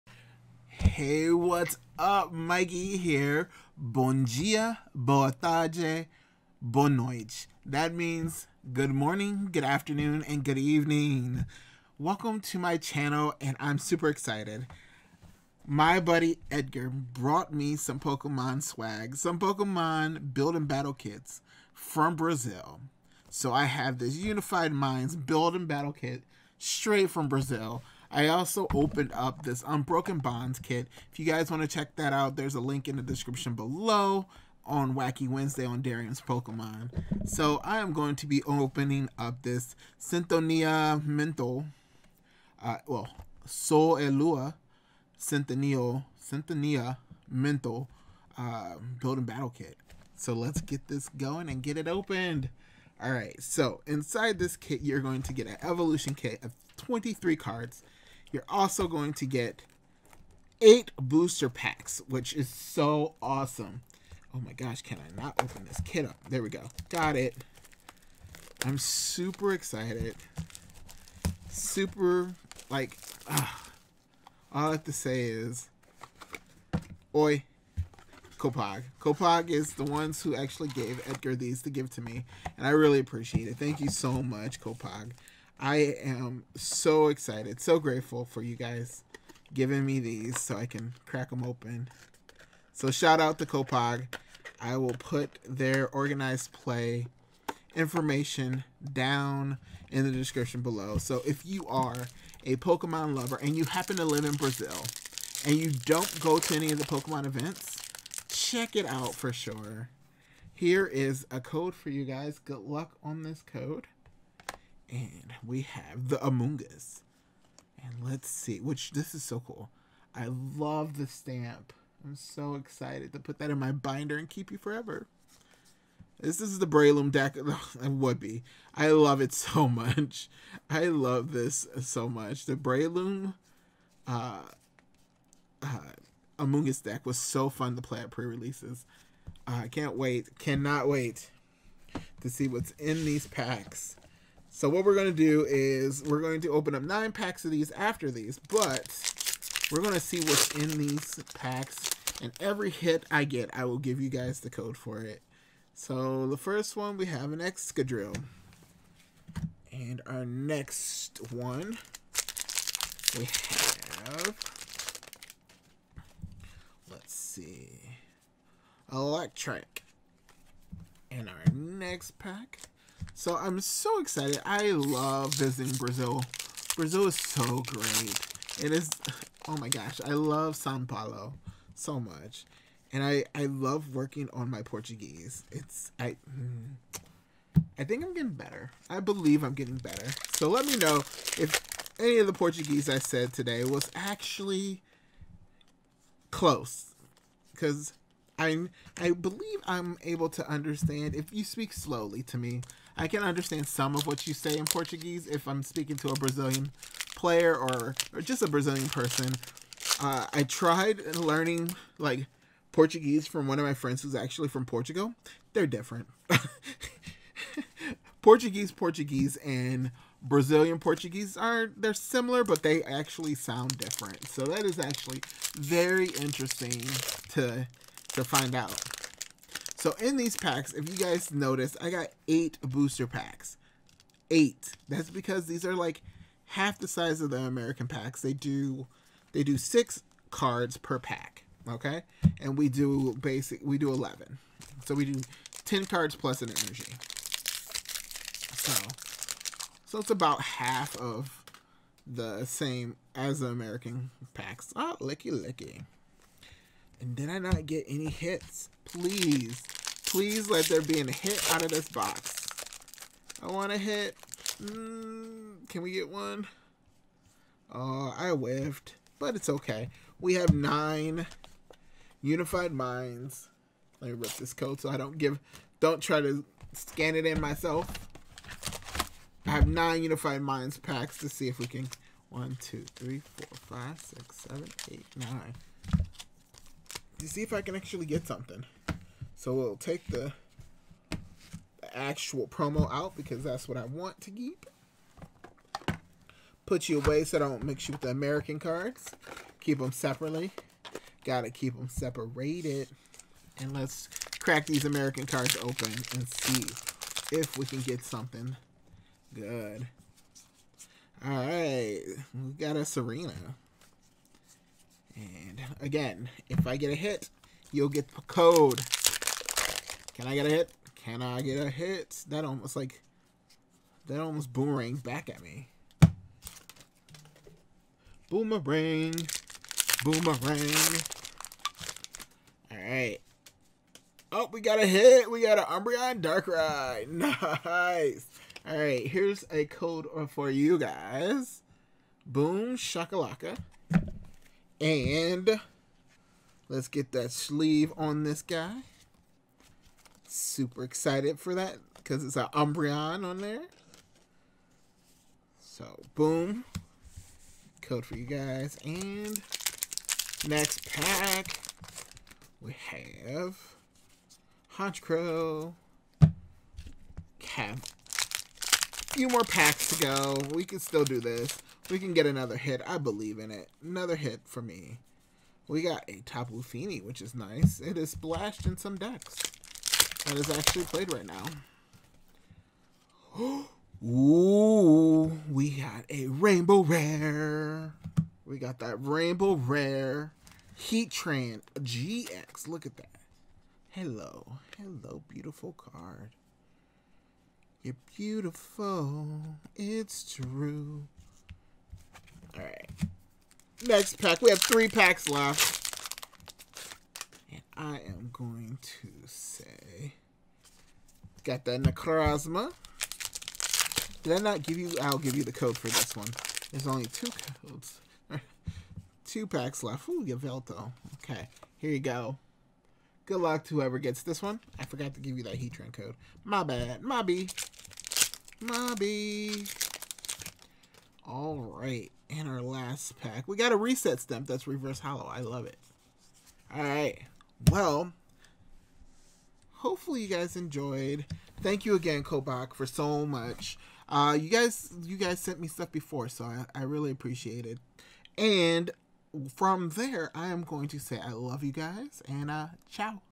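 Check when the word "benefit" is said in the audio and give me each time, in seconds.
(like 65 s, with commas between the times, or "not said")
not said.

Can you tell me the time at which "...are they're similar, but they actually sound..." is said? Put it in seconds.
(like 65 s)
221 s.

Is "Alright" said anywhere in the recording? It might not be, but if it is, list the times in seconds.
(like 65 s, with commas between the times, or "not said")
332 s, 338 s.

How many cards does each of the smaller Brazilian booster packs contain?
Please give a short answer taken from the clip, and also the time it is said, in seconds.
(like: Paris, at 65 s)
6, at 239 s.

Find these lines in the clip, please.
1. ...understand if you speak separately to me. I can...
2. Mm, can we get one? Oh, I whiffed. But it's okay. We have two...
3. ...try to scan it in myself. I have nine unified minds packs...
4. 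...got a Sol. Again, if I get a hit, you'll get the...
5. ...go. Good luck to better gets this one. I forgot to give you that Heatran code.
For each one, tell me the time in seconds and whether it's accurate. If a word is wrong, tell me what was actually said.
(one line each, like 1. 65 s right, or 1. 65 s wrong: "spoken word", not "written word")
1. 200 s wrong: "slowly", not "separately"
2. 264 s wrong: "nine", not "two"
3. 276 s right
4. 312 s wrong: "Serena", not "Sol"
5. 421 s wrong: "whoever", not "better".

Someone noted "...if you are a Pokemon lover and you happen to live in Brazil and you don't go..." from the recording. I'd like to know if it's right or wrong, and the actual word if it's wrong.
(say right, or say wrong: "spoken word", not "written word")
right.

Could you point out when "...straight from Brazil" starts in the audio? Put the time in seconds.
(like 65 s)
26 s.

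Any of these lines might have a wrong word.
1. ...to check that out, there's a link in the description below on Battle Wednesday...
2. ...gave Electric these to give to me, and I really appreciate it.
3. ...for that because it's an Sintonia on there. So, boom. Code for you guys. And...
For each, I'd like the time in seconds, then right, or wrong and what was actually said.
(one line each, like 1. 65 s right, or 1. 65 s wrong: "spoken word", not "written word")
1. 31 s wrong: "Wacky", not "Battle"
2. 80 s wrong: "Edgar", not "Electric"
3. 351 s wrong: "Umbreon", not "Sintonia".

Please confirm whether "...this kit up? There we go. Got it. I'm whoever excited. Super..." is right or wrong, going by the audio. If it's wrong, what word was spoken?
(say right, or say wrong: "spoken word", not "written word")
wrong: "super", not "whoever".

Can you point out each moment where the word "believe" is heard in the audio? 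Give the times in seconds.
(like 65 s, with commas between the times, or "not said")
189 s, 199 s, 372 s.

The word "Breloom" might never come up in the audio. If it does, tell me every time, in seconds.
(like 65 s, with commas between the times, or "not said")
126 s, 132 s.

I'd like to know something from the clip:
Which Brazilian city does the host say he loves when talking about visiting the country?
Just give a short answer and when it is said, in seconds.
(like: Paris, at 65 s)
Sao Paulo, at 180 s.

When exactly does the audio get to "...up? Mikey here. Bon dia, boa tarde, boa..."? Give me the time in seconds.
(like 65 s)
1 s.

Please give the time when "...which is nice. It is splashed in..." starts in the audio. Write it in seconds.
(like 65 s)
377 s.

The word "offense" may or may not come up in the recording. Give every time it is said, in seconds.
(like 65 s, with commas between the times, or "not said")
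not said.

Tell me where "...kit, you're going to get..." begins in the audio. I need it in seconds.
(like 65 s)
54 s.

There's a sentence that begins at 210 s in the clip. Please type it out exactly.
Uh, I tried learning like Portuguese from one of my friends who's actually from Portugal.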